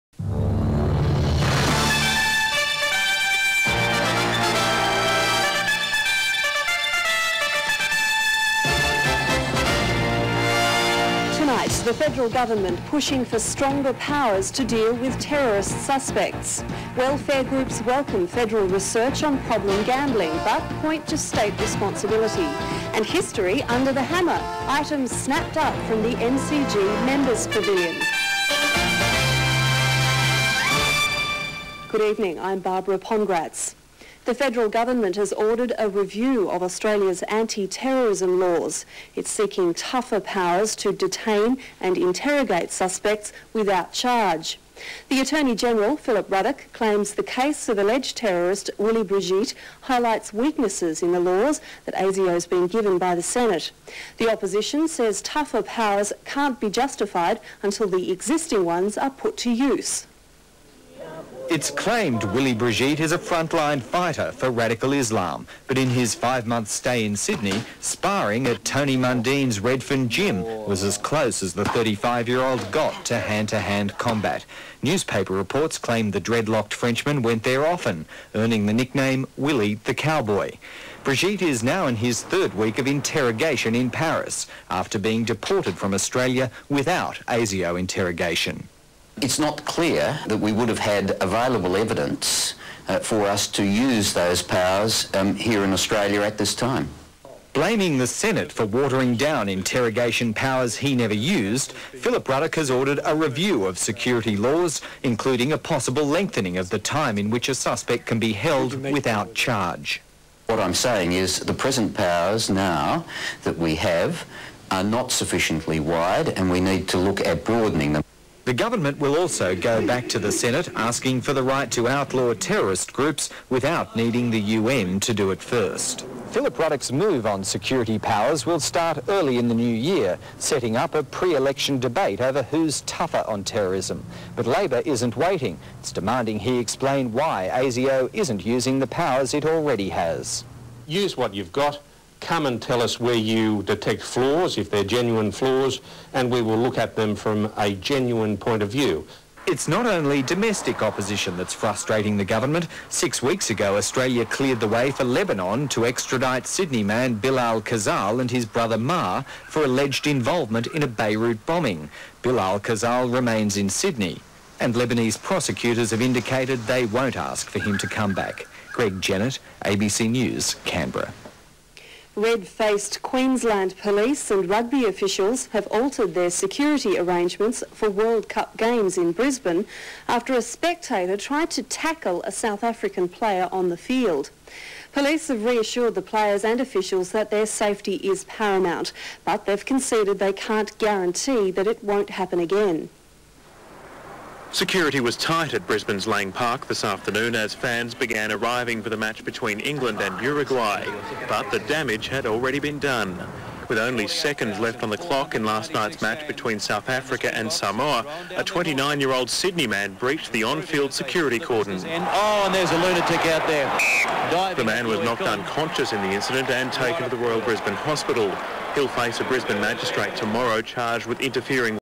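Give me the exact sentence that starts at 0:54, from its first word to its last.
The opposition says tougher powers can't be justified until the existing ones are put to use.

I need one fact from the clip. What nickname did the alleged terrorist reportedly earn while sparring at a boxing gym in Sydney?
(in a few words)
Willy the Cowboy.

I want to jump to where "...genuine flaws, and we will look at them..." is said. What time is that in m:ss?
2:24.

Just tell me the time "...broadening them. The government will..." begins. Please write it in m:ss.
1:57.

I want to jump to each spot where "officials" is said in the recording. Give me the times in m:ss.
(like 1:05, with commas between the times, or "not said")
2:54, 3:06.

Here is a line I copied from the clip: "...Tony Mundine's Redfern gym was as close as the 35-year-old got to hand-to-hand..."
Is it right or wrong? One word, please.
right.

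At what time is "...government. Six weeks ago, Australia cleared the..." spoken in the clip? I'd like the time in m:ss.
2:32.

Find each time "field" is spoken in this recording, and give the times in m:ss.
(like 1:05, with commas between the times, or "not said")
3:03, 3:30.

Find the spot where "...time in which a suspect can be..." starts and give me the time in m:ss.
1:46.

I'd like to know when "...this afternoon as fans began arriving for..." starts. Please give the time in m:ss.
3:16.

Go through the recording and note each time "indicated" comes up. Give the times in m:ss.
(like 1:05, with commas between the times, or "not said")
2:46.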